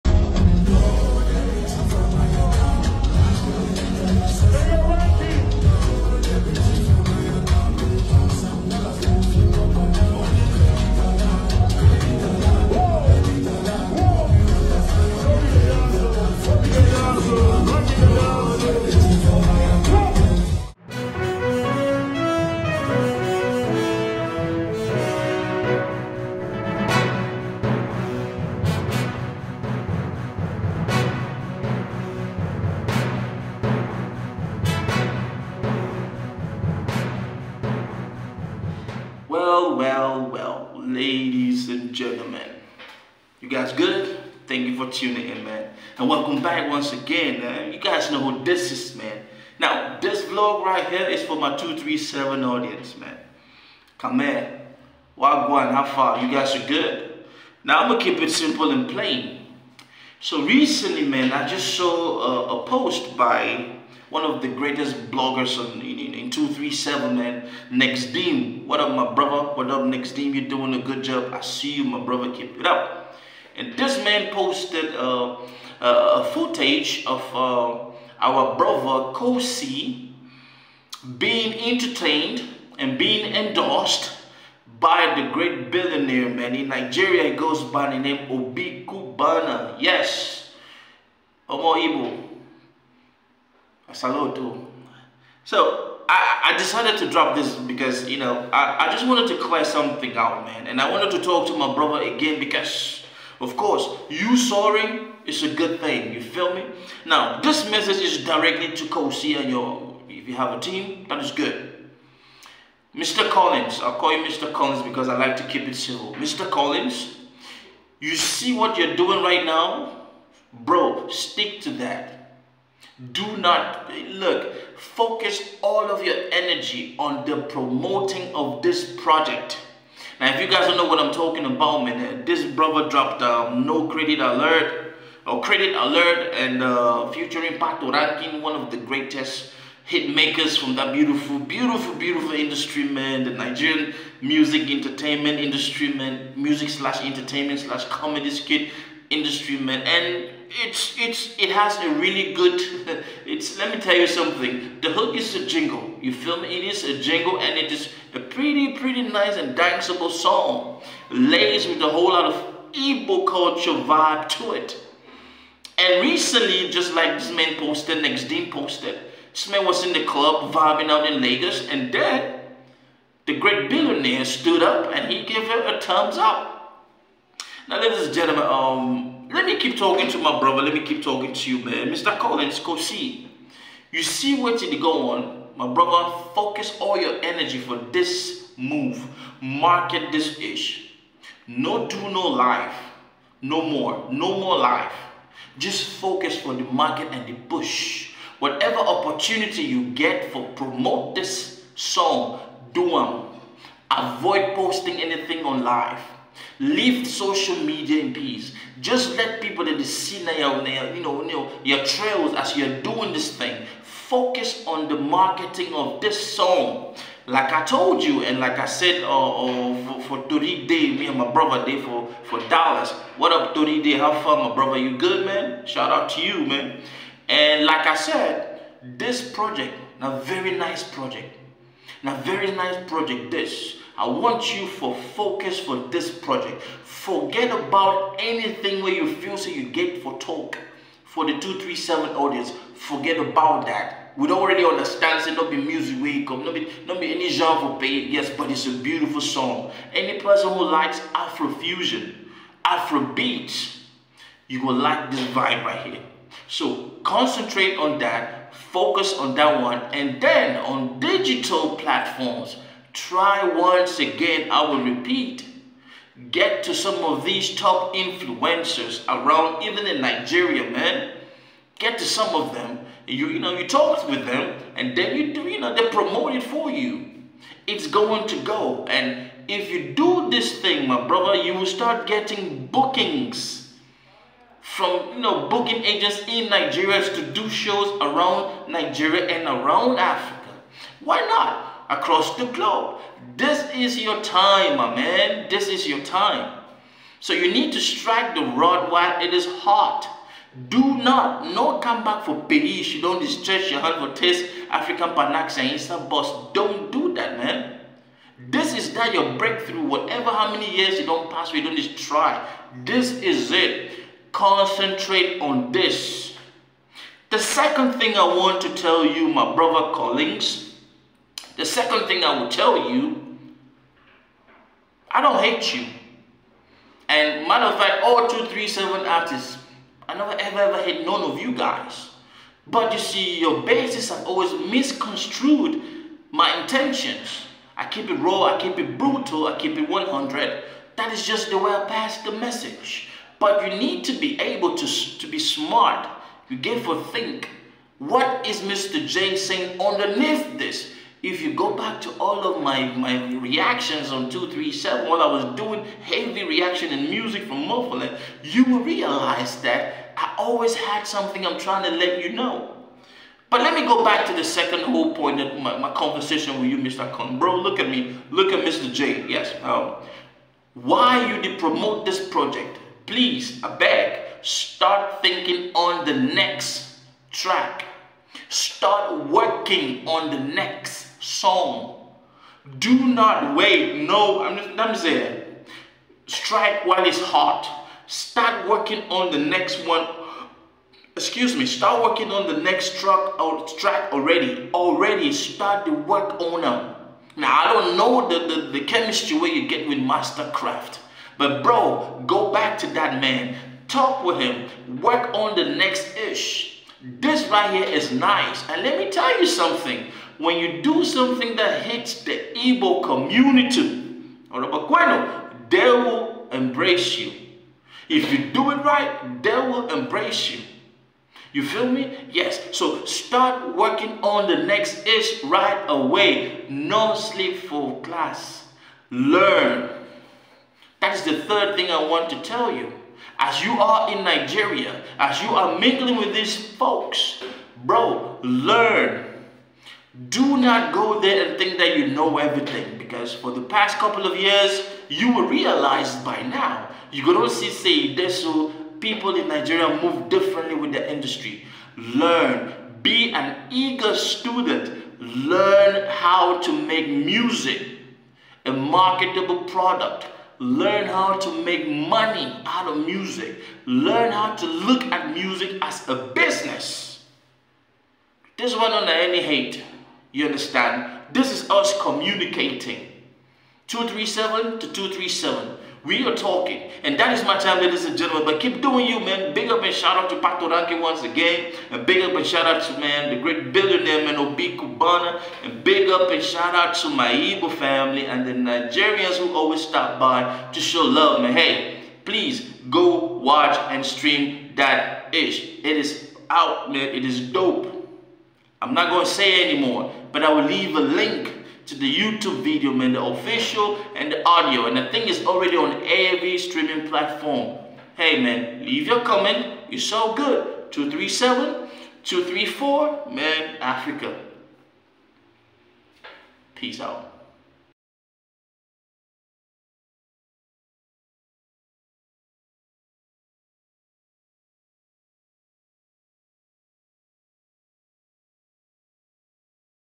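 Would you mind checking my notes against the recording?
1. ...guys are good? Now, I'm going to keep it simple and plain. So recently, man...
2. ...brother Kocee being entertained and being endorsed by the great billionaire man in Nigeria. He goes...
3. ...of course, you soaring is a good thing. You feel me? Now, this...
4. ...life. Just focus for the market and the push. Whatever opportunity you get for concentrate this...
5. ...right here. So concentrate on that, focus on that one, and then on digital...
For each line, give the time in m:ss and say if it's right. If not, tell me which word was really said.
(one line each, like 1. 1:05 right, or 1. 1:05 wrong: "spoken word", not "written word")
1. 0:56 right
2. 1:18 right
3. 1:43 right
4. 3:14 wrong: "promote", not "concentrate"
5. 4:15 right.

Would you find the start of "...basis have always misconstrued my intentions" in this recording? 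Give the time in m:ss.
5:33.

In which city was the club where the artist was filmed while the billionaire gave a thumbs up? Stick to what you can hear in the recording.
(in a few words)
Lagos.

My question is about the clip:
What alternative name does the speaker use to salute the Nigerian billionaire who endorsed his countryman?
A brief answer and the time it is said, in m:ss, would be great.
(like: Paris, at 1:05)
Omo Ibu, at 1:31.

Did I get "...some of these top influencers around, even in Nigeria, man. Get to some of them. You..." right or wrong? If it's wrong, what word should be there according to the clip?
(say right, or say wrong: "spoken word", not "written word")
right.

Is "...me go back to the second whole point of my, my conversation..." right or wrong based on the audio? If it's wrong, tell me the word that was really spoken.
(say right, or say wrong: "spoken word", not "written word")
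right.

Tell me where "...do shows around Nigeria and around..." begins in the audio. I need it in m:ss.
4:47.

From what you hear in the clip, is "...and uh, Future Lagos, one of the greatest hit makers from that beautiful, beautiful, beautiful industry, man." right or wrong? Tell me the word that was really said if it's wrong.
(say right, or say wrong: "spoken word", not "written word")
wrong: "Patoranking", not "Lagos".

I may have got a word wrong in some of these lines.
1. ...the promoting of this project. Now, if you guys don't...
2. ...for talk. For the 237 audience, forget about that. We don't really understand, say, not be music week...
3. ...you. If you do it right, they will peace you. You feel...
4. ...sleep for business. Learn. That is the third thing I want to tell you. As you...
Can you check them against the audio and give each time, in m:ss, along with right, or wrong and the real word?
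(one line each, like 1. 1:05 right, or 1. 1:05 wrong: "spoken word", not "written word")
1. 2:07 right
2. 4:00 right
3. 6:57 wrong: "embrace", not "peace"
4. 7:07 wrong: "class", not "business".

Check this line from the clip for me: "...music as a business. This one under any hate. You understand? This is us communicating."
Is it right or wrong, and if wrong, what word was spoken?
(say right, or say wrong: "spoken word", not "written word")
right.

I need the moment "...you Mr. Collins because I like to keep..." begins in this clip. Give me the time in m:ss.
1:54.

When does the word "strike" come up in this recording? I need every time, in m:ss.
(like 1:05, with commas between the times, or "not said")
4:57, 6:26.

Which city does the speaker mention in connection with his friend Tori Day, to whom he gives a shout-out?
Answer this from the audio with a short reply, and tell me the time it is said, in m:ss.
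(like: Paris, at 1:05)
Dallas, at 3:42.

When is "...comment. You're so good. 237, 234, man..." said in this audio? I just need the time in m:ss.
8:29.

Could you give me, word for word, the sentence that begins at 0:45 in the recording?
And welcome back once again, man.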